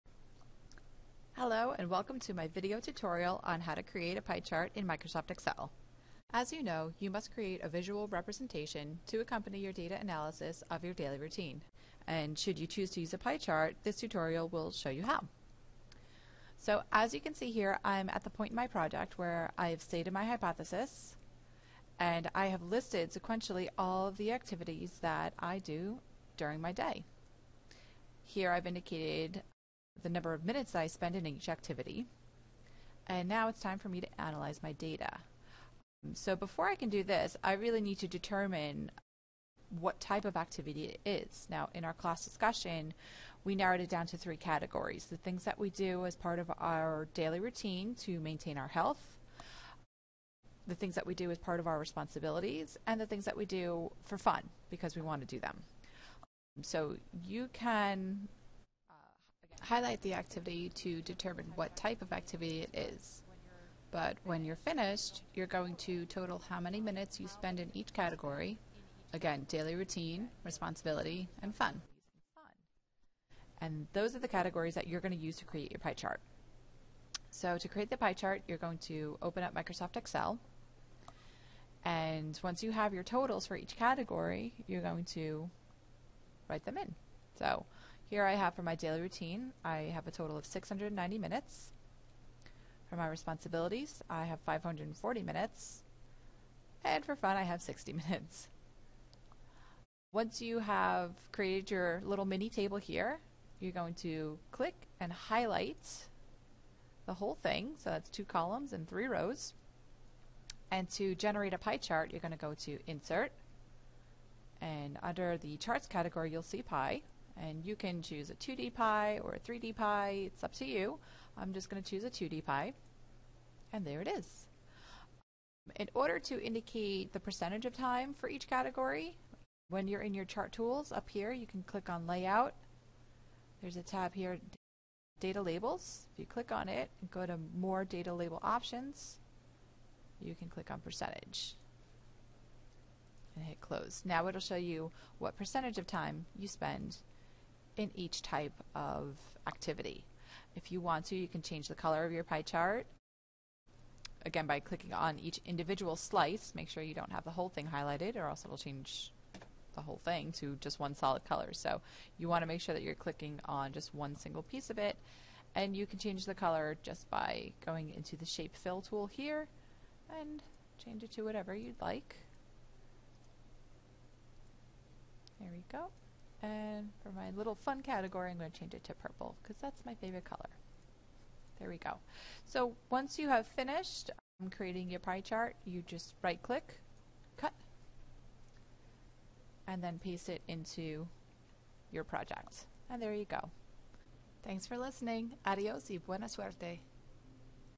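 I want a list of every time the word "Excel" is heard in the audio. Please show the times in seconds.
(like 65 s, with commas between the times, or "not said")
5 s, 79 s.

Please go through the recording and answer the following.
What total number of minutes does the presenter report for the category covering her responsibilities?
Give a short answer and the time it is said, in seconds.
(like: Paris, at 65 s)
540, at 94 s.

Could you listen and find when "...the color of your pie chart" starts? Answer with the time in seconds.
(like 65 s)
151 s.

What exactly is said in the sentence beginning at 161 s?
So you want to make sure that you're clicking on just one single piece of it.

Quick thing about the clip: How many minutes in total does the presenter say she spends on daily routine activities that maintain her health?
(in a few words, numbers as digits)
690.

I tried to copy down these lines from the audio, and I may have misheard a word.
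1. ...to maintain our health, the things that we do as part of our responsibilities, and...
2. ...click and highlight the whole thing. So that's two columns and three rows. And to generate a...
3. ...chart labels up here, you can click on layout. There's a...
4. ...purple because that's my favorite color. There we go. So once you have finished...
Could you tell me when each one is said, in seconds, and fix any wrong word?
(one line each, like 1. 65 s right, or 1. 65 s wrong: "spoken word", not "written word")
1. 48 s right
2. 104 s right
3. 130 s wrong: "tools", not "labels"
4. 178 s right.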